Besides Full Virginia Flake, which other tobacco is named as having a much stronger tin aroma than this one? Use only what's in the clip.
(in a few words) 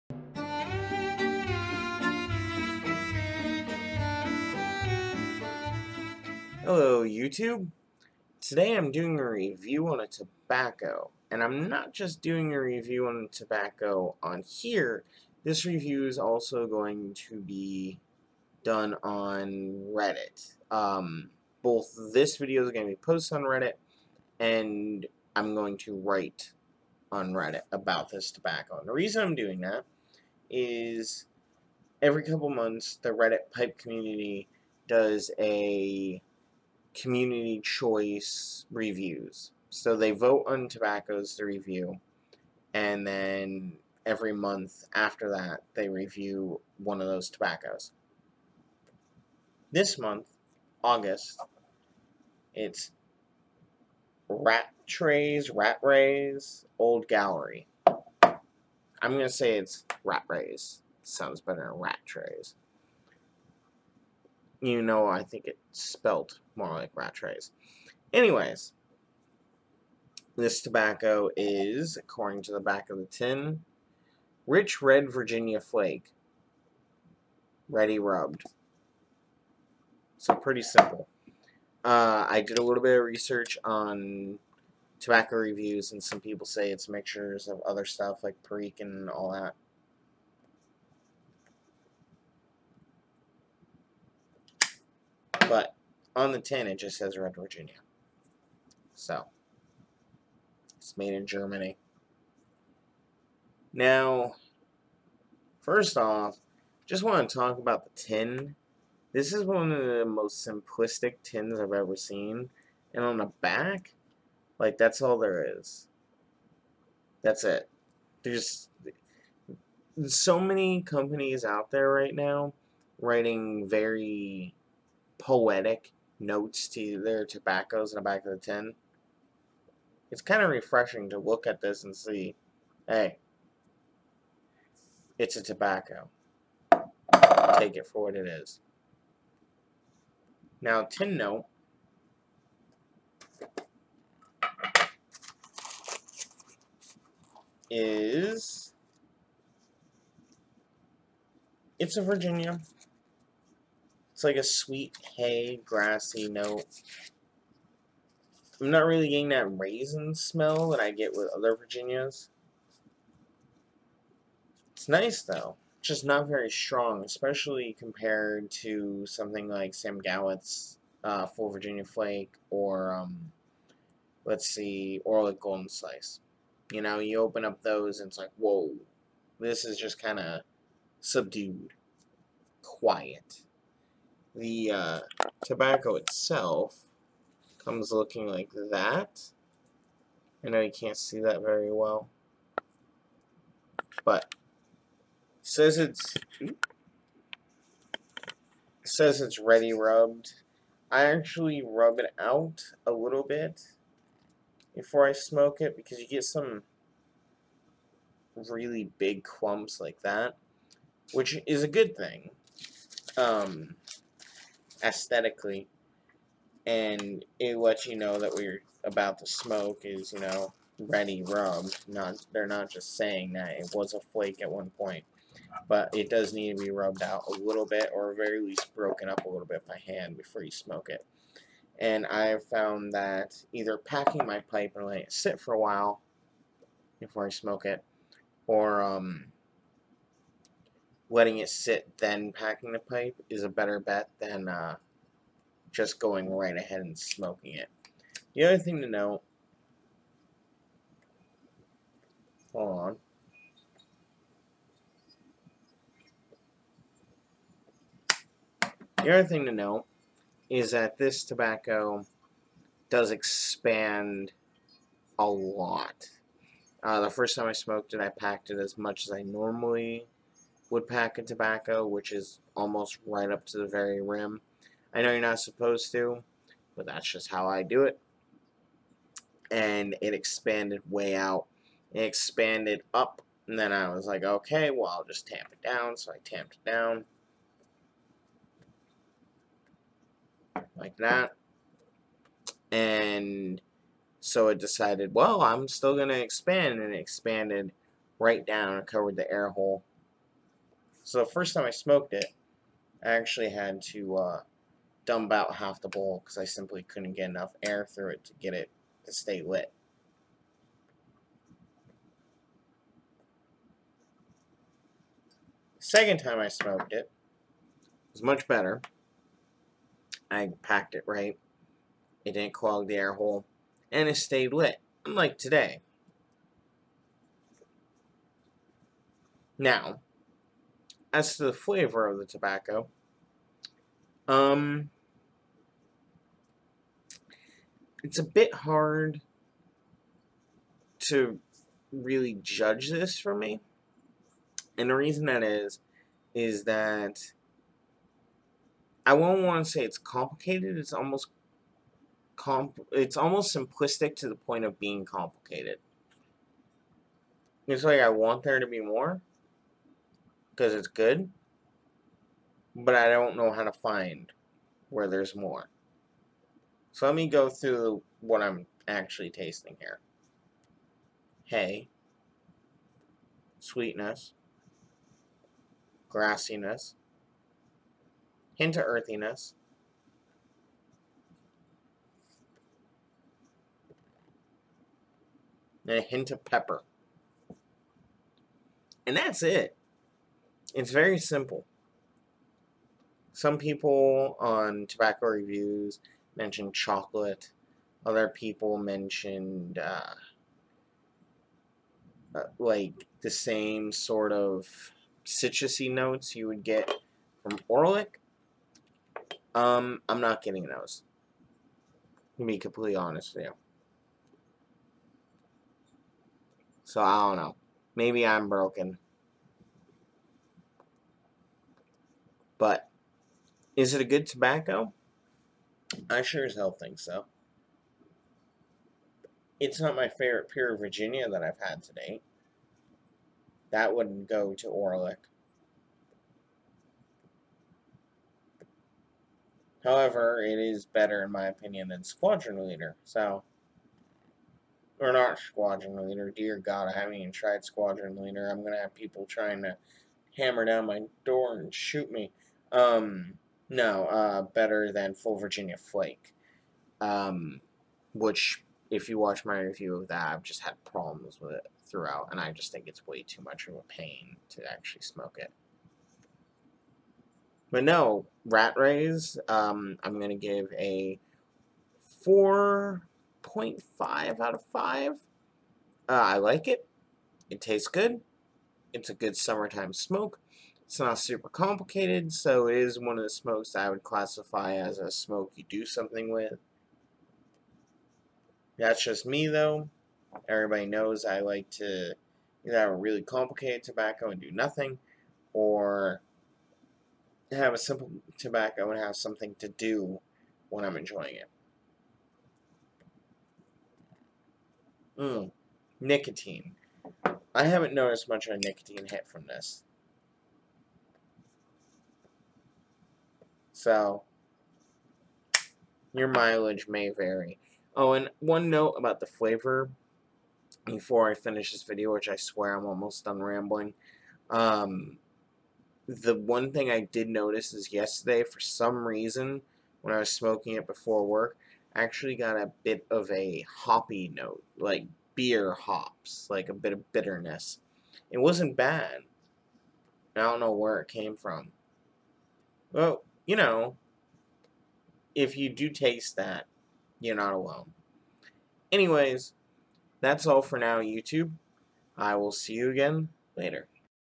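Golden Slice.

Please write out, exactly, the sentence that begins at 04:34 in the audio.
I know you're not supposed to, but that's just how I do it.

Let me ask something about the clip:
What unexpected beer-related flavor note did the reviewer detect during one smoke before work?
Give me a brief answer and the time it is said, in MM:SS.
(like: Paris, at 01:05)
hoppy, at 08:53.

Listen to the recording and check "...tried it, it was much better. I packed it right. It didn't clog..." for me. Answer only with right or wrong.
wrong.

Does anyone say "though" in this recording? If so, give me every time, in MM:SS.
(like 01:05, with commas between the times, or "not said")
02:45, 08:09.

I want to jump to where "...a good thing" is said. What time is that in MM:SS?
03:31.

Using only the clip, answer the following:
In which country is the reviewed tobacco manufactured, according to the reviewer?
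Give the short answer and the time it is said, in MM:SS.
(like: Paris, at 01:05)
Germany, at 01:41.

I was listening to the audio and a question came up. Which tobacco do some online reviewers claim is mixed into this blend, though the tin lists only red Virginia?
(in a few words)
Perique.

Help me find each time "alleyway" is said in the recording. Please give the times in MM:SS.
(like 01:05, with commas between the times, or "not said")
not said.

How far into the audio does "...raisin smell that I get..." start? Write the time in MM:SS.
02:39.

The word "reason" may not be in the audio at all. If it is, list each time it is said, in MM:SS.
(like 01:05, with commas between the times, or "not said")
00:28, 05:44, 08:49.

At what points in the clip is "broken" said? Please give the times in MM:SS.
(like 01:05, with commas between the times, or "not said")
03:48, 06:58.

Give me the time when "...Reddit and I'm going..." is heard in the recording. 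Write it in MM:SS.
00:23.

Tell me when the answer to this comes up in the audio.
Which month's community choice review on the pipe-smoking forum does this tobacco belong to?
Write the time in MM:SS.
00:50.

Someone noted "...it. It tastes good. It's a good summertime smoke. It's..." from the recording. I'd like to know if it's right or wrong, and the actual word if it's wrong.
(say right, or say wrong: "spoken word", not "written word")
right.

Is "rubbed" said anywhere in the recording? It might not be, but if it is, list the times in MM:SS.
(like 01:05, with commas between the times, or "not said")
01:17, 03:19, 03:46.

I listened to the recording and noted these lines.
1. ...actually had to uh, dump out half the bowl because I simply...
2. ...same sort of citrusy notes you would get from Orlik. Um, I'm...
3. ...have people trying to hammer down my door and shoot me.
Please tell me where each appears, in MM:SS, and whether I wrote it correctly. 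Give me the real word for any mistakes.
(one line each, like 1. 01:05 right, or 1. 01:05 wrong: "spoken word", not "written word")
1. 05:03 right
2. 06:43 right
3. 07:28 right.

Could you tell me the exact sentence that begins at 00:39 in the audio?
So they vote on tobaccos to review, and then every month after that, they review one of those tobaccos.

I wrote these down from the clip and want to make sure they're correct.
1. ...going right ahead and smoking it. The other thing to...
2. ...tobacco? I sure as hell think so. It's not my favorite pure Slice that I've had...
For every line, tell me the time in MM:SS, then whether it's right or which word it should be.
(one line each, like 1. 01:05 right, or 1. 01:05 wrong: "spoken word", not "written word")
1. 04:05 right
2. 07:04 wrong: "Virginia", not "Slice".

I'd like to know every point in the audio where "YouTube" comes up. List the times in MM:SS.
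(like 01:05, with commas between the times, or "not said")
00:07, 09:11.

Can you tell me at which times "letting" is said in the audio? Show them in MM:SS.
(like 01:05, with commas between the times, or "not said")
03:54, 04:01.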